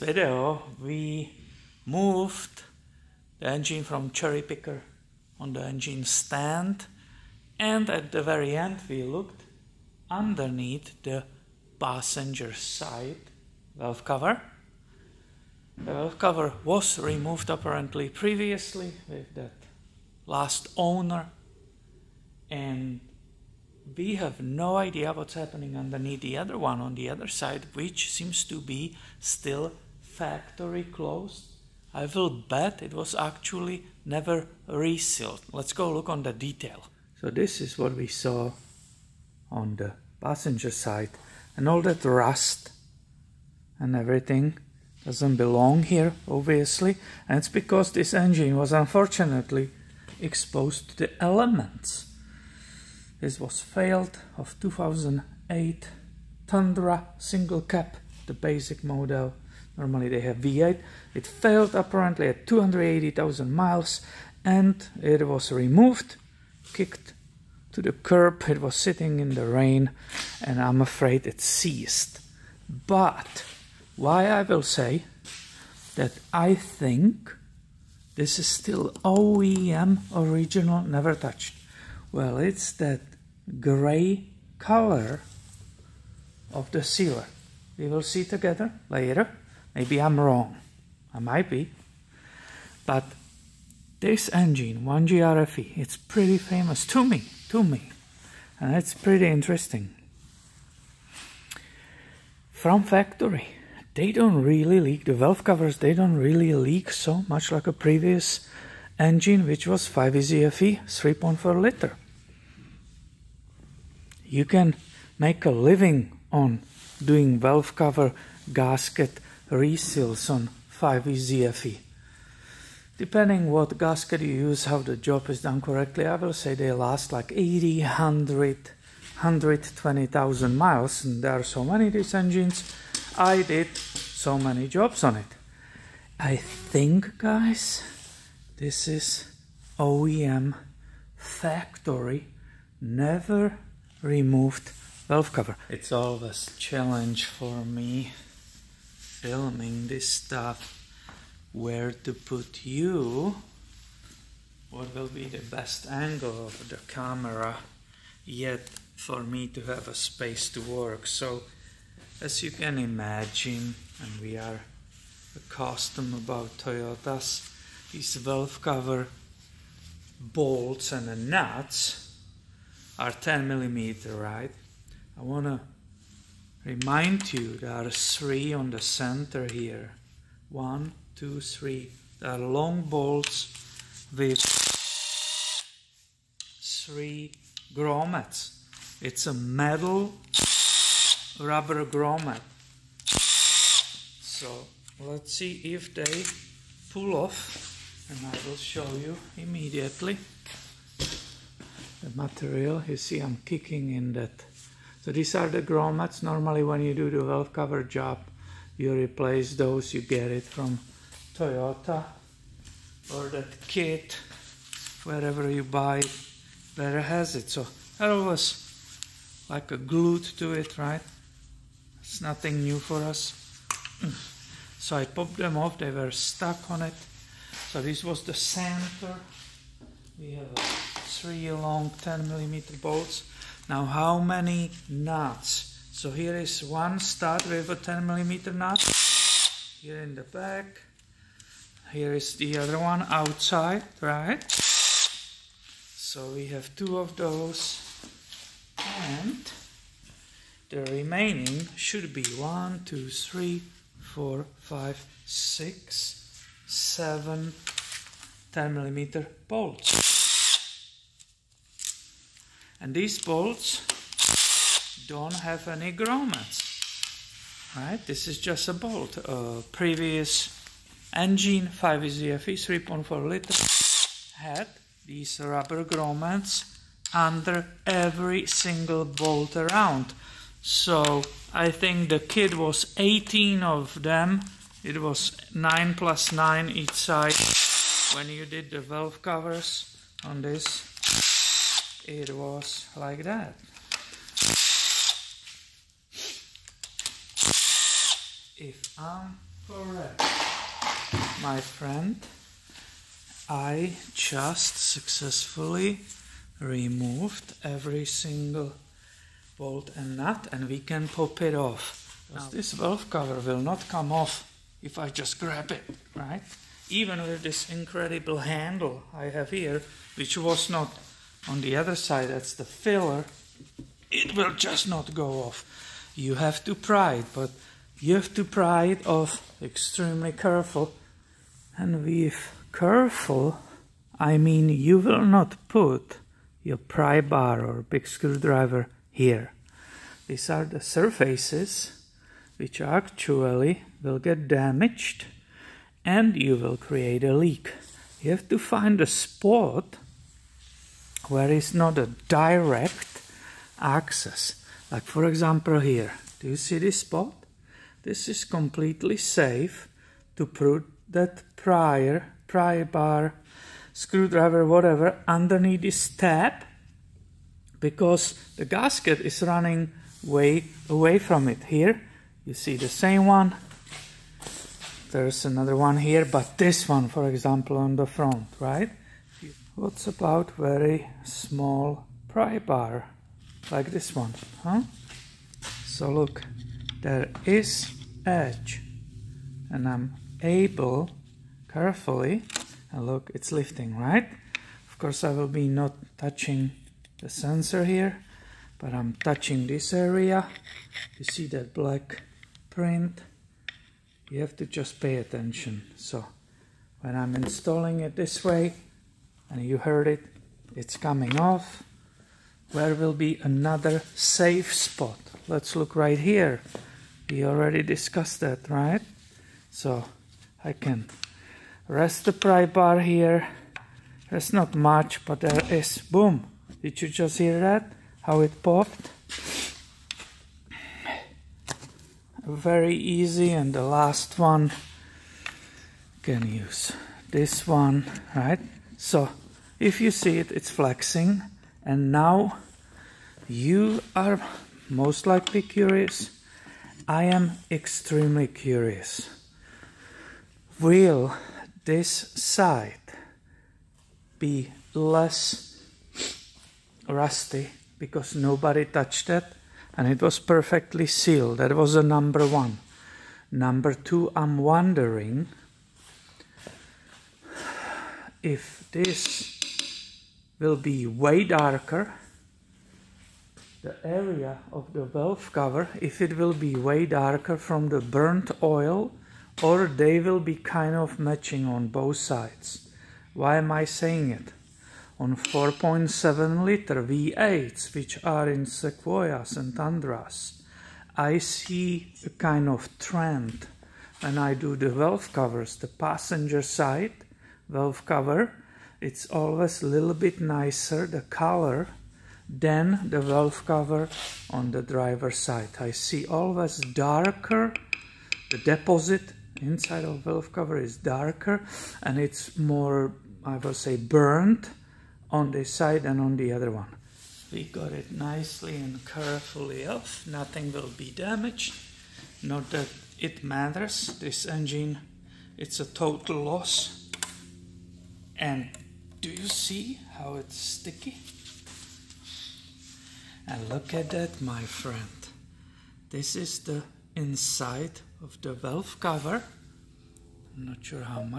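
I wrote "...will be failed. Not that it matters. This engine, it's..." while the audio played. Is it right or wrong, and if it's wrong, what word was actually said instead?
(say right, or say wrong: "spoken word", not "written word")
wrong: "damaged", not "failed".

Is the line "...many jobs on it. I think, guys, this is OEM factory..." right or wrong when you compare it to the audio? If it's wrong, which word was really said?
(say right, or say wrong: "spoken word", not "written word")
right.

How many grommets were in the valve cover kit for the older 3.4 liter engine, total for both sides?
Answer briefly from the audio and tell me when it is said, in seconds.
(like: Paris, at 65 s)
18, at 282 s.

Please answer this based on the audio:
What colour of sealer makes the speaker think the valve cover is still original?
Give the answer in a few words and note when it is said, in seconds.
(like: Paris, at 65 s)
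Gray, at 83 s.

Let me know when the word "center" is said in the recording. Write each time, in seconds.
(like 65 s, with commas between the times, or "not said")
178 s, 228 s.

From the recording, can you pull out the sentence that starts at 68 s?
It was sitting in the rain, and I'm afraid it ceased.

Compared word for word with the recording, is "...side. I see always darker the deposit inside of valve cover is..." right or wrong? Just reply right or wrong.
right.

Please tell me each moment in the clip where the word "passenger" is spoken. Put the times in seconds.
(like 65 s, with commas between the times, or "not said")
11 s, 40 s, 495 s.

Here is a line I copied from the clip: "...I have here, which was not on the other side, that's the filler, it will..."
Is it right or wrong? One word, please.
right.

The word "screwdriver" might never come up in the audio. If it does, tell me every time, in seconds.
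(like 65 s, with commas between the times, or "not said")
338 s, 363 s.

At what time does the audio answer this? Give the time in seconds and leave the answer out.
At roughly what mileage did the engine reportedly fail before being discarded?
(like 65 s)
62 s.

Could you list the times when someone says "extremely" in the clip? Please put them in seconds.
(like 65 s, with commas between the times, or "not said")
329 s, 447 s.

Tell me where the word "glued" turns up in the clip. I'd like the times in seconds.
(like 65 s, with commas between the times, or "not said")
219 s.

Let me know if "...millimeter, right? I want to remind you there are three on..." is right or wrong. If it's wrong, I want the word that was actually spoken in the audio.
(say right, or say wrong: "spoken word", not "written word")
right.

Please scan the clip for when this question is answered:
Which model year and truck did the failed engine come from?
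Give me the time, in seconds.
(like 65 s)
54 s.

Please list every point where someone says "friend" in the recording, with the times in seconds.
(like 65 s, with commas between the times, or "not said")
301 s, 534 s.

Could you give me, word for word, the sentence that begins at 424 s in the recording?
There's not much, but there is.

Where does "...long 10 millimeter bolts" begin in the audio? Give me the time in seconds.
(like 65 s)
231 s.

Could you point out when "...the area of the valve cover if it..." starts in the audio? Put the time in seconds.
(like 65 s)
473 s.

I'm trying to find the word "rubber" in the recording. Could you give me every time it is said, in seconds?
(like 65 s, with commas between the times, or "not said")
191 s, 275 s.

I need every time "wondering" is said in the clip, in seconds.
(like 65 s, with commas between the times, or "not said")
464 s.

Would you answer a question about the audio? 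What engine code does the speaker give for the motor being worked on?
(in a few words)
1GRFE.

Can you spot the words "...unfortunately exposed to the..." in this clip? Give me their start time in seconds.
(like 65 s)
48 s.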